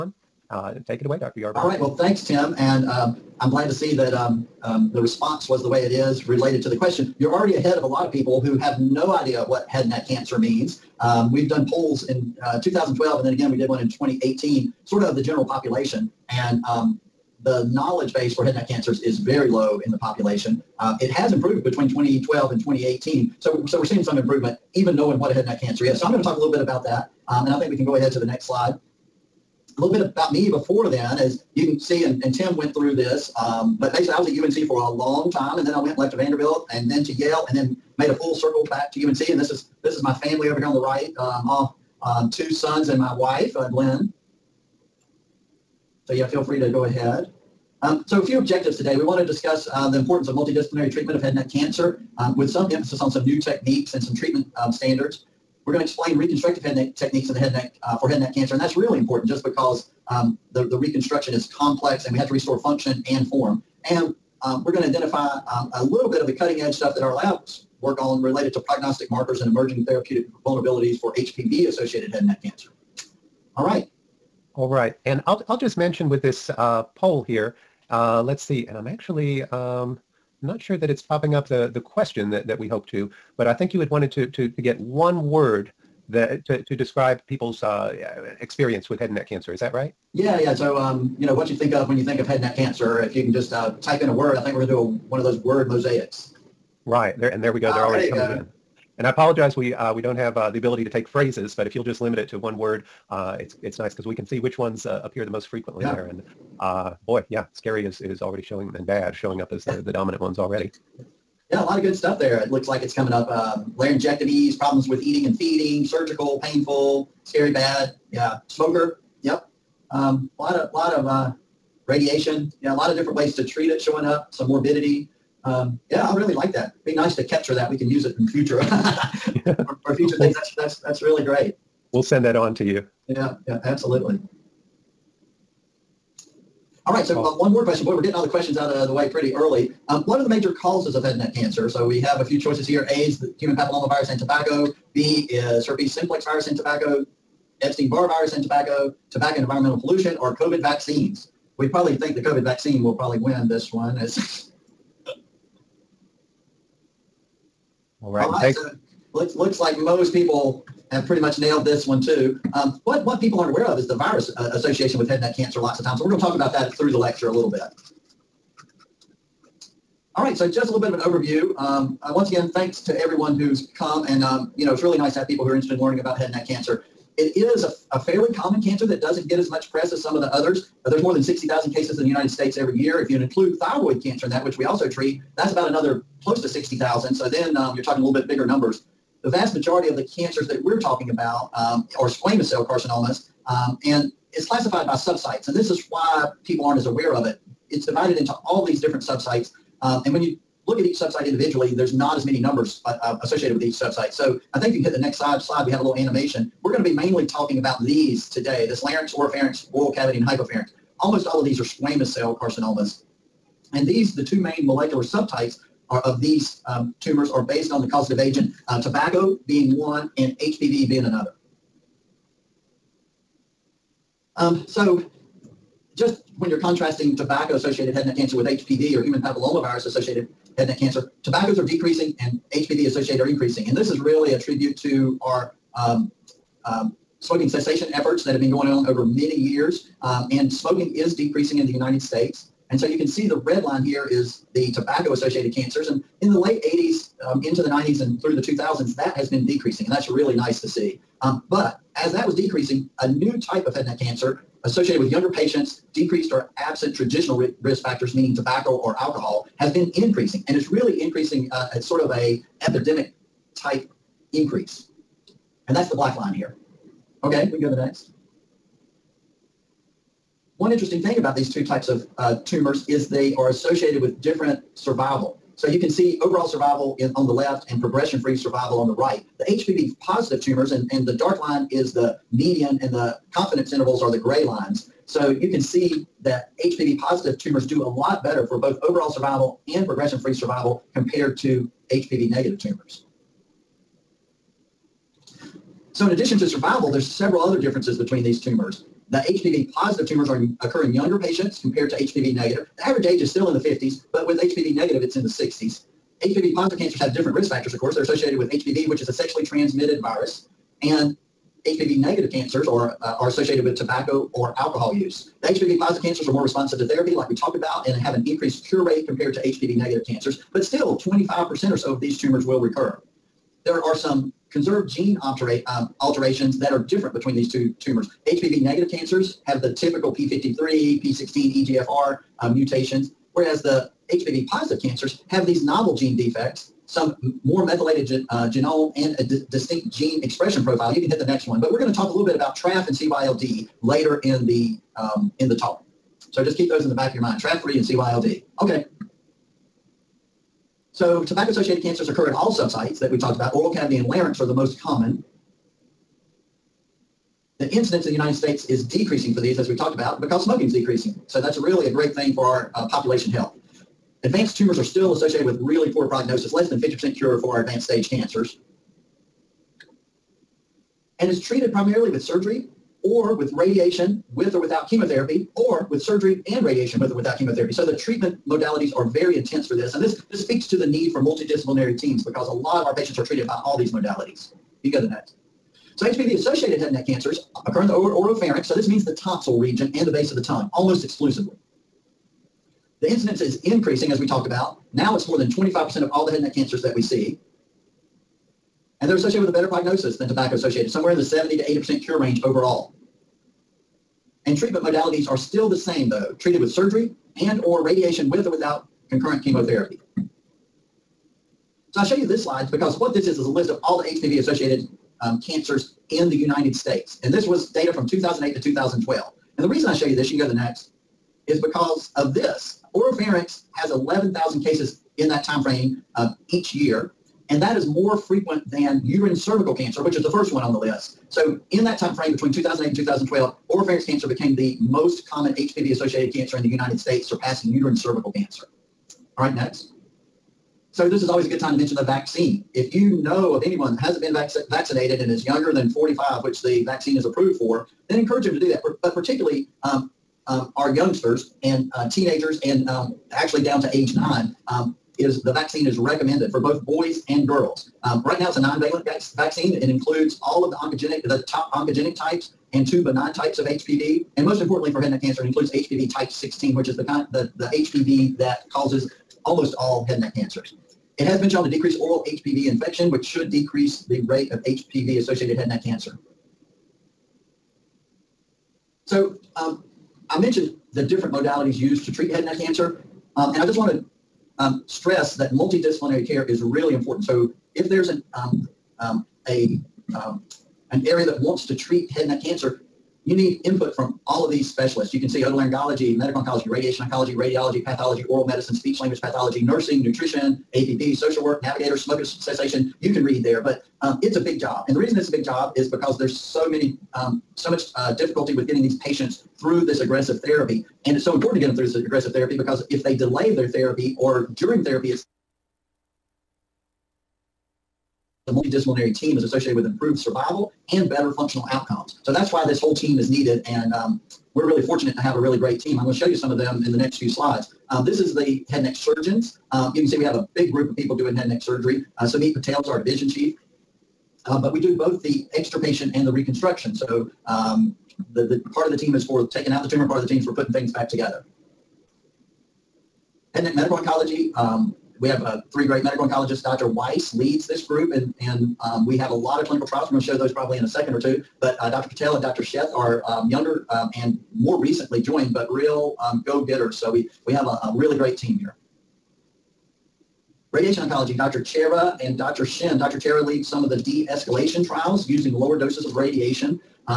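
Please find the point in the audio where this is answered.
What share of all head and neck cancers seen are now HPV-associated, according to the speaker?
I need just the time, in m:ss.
6:35.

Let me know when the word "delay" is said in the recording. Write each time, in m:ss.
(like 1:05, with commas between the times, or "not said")
8:33.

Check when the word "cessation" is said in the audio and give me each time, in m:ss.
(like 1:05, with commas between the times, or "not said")
3:57, 8:22.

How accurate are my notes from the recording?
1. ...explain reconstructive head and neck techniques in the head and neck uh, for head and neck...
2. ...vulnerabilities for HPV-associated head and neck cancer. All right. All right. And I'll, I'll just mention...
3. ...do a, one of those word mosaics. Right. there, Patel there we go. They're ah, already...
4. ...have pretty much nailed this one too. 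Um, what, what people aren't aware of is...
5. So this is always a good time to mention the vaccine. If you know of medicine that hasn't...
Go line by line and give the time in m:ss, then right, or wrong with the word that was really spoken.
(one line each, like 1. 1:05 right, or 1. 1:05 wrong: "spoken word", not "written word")
1. 0:55 right
2. 1:10 right
3. 1:34 wrong: "And", not "Patel"
4. 2:40 right
5. 7:20 wrong: "anyone", not "medicine".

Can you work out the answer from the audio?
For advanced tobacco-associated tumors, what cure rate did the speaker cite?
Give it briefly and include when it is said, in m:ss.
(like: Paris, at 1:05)
less than 50%, at 6:06.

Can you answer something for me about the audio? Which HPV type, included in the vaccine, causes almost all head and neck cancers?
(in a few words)
HPV type 16.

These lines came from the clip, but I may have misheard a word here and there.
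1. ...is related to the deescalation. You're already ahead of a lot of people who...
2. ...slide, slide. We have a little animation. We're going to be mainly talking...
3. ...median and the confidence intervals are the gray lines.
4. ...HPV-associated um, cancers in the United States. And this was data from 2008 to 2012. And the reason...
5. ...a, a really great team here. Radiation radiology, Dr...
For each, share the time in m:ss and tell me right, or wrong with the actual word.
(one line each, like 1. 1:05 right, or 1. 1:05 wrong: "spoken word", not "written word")
1. 0:05 wrong: "question", not "deescalation"
2. 3:25 right
3. 4:42 right
4. 6:54 right
5. 9:17 wrong: "oncology", not "radiology".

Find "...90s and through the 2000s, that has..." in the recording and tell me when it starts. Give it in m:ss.
4:07.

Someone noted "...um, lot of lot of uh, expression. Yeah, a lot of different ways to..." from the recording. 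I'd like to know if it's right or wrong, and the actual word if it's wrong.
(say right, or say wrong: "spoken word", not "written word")
wrong: "radiation", not "expression".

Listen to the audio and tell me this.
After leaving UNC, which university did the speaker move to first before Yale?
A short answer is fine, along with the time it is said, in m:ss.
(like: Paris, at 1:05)
Vanderbilt, at 0:36.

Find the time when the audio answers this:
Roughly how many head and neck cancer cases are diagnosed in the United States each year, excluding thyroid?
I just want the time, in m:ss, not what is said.
3:01.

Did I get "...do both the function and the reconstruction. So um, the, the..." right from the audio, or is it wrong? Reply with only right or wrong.
wrong.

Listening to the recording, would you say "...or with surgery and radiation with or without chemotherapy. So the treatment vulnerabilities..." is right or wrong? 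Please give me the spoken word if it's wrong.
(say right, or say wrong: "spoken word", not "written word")
wrong: "modalities", not "vulnerabilities".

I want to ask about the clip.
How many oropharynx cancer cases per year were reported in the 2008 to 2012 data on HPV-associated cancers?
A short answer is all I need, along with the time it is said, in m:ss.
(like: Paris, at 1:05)
11,000, at 7:03.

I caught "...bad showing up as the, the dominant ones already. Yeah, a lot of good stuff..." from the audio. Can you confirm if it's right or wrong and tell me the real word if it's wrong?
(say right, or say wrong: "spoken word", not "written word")
right.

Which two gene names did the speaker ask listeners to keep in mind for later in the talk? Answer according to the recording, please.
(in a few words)
TRAF3 and CYLD.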